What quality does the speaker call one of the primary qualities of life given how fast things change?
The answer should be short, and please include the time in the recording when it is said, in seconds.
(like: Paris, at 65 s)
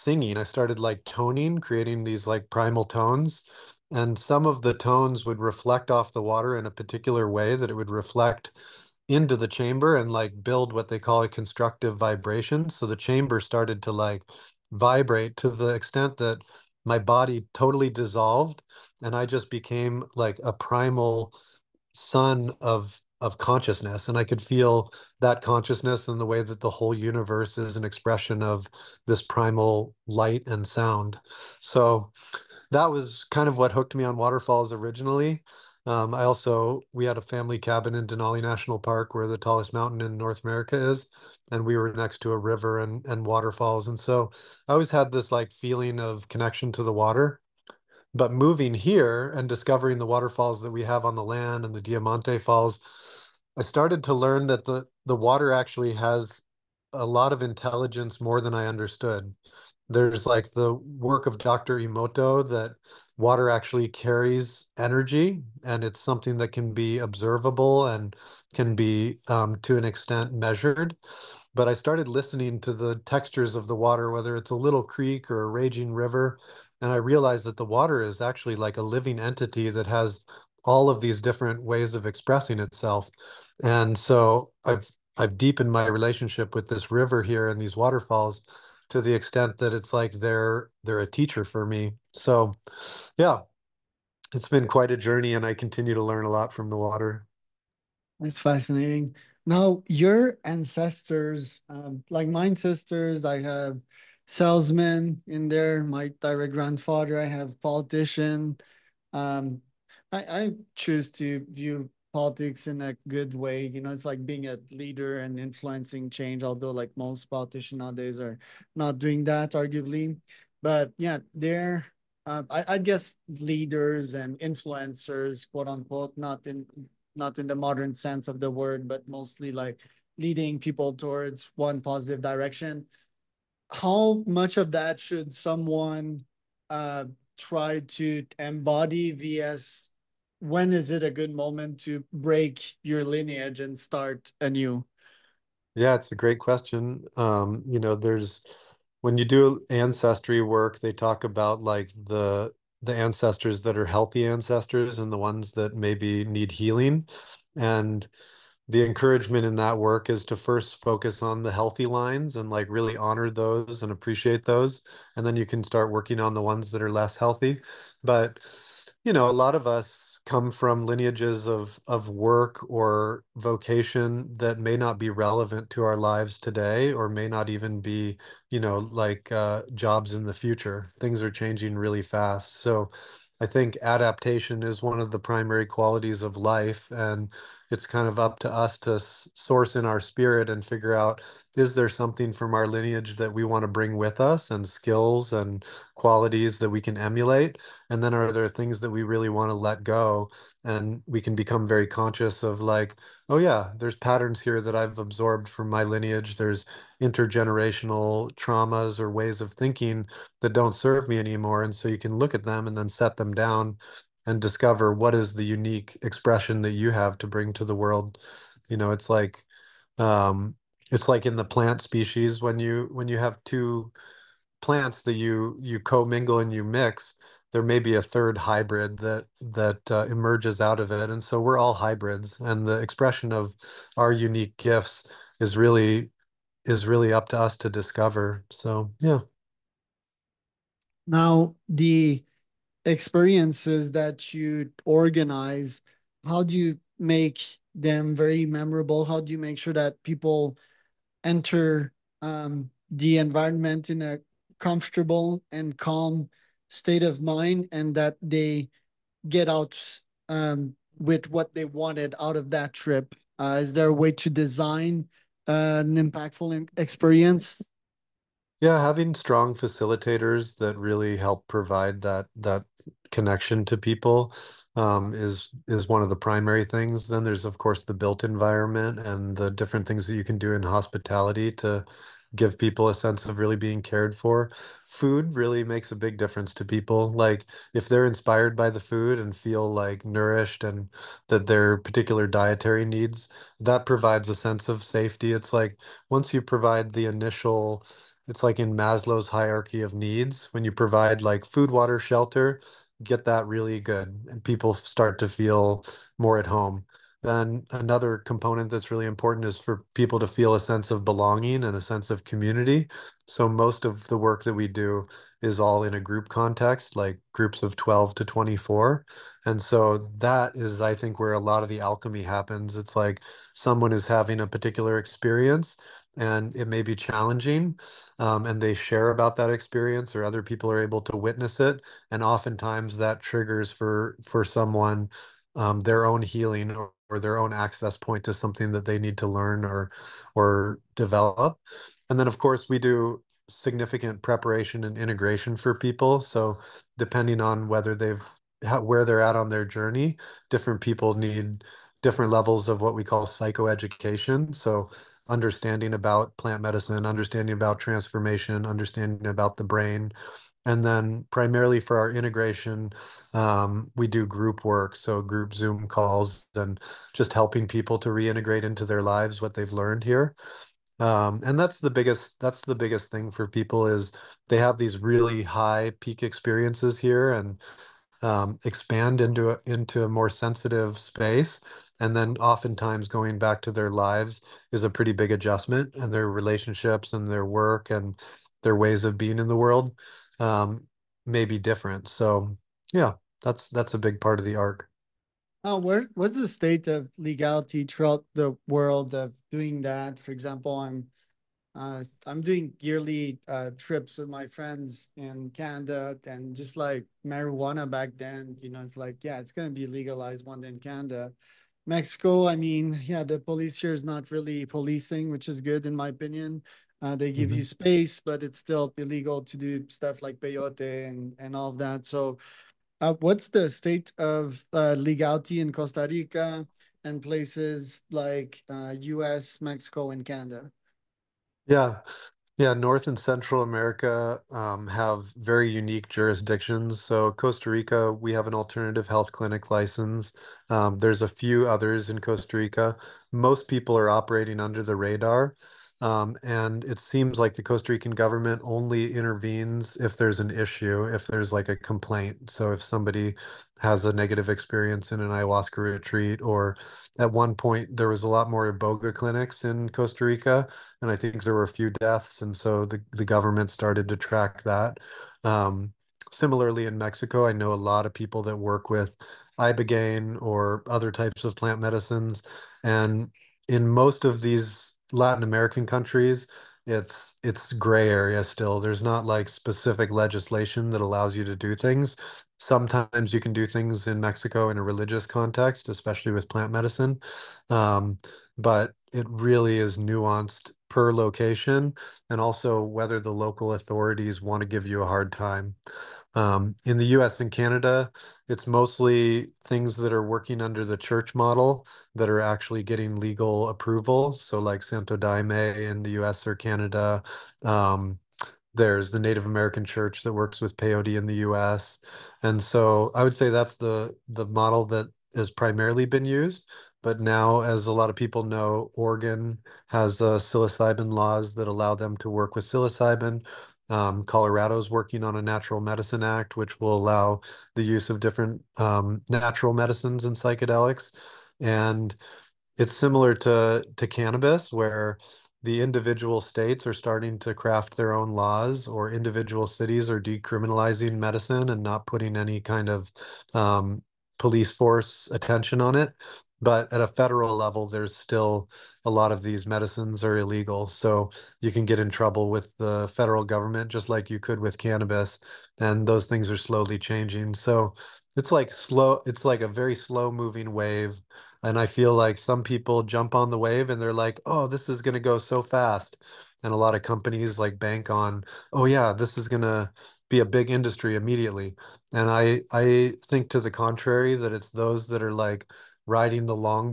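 adaptation, at 183 s.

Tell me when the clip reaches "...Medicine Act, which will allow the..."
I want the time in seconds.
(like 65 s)
525 s.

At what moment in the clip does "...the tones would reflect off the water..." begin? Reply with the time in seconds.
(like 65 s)
4 s.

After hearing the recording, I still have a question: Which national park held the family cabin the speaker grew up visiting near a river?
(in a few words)
Denali National Park.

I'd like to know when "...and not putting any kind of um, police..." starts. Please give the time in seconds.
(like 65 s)
541 s.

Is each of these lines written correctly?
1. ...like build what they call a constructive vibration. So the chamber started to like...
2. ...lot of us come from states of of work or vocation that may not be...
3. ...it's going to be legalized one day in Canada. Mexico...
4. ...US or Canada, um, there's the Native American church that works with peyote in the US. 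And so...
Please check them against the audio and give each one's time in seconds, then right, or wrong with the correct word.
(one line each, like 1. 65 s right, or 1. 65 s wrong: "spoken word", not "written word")
1. 10 s right
2. 169 s wrong: "lineages", not "states"
3. 409 s right
4. 506 s right.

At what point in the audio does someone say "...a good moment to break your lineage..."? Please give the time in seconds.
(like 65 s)
141 s.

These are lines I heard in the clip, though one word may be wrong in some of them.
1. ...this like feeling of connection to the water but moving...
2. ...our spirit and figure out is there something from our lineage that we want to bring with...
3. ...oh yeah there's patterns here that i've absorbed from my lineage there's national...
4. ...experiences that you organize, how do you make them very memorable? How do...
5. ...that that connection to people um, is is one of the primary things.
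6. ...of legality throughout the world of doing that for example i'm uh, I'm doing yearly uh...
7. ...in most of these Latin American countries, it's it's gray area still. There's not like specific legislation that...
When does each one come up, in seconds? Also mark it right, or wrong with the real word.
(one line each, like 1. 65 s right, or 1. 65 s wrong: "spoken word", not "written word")
1. 45 s right
2. 189 s right
3. 203 s wrong: "intergenerational", not "national"
4. 242 s right
5. 272 s right
6. 396 s right
7. 473 s right.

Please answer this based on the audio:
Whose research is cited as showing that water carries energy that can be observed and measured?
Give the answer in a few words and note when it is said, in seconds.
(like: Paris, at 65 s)
Dr. Emoto, at 61 s.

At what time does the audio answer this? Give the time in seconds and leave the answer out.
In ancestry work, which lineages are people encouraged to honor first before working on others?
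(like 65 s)
161 s.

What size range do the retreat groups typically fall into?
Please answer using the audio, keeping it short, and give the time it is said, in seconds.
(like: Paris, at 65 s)
12 to 24, at 317 s.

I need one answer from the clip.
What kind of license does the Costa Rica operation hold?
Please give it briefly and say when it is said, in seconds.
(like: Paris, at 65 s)
alternative health clinic license, at 438 s.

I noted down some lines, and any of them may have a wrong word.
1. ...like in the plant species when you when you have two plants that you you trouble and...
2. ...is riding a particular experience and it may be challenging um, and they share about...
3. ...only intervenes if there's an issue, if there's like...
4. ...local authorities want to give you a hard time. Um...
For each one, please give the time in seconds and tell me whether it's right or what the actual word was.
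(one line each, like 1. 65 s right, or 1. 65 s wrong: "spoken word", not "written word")
1. 221 s wrong: "commingle", not "trouble"
2. 323 s wrong: "having", not "riding"
3. 448 s right
4. 493 s right.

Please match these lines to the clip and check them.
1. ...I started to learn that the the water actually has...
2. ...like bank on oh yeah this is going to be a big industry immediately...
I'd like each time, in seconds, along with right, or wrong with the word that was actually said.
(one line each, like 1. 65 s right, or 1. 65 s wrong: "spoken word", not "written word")
1. 53 s right
2. 567 s right.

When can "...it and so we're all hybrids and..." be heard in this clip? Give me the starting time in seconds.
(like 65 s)
230 s.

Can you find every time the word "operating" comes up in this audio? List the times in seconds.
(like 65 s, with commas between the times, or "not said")
444 s.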